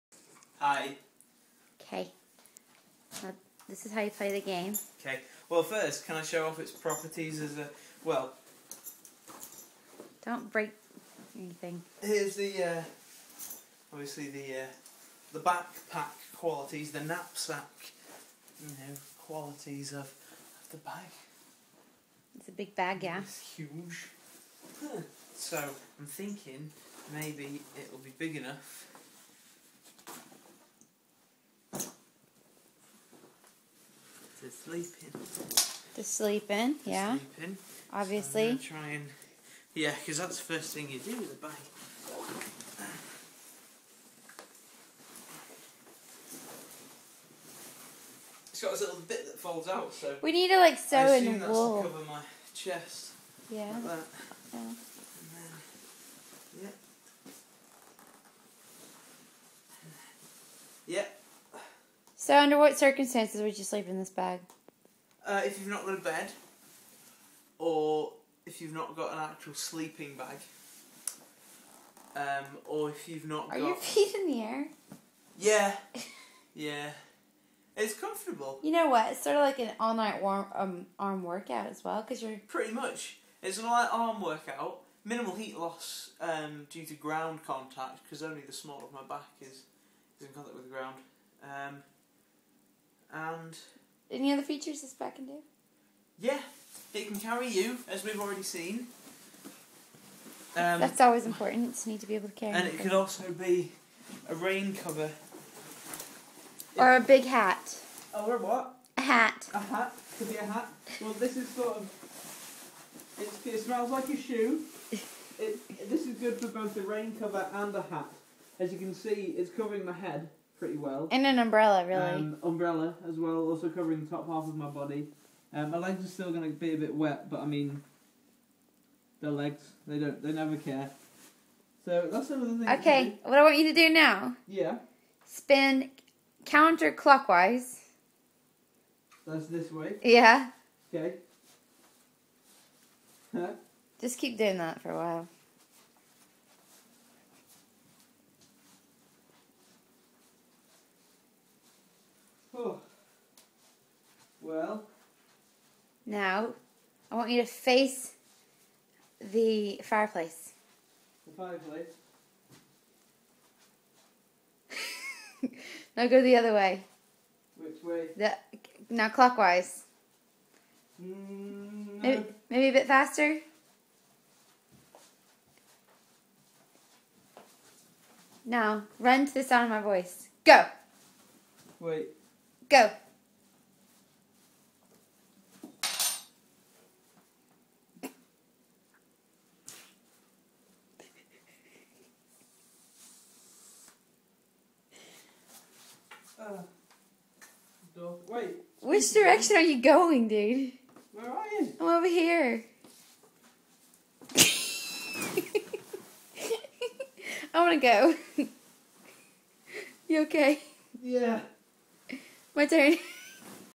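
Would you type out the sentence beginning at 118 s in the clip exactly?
As you can see, it's covering my head pretty well.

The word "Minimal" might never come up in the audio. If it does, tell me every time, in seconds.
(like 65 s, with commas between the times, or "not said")
85 s.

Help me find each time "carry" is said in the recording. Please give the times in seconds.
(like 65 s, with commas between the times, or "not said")
97 s, 102 s.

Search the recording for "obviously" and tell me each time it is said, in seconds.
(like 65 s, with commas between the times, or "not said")
13 s, 37 s.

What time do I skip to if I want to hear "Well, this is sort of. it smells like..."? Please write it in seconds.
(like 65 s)
111 s.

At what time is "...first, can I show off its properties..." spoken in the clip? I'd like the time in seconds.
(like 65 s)
5 s.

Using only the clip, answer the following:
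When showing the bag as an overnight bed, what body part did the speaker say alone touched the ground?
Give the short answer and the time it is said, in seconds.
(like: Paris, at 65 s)
The small of my back, at 88 s.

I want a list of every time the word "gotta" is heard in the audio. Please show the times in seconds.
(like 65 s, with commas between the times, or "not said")
not said.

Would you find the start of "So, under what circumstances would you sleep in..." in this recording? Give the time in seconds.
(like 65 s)
62 s.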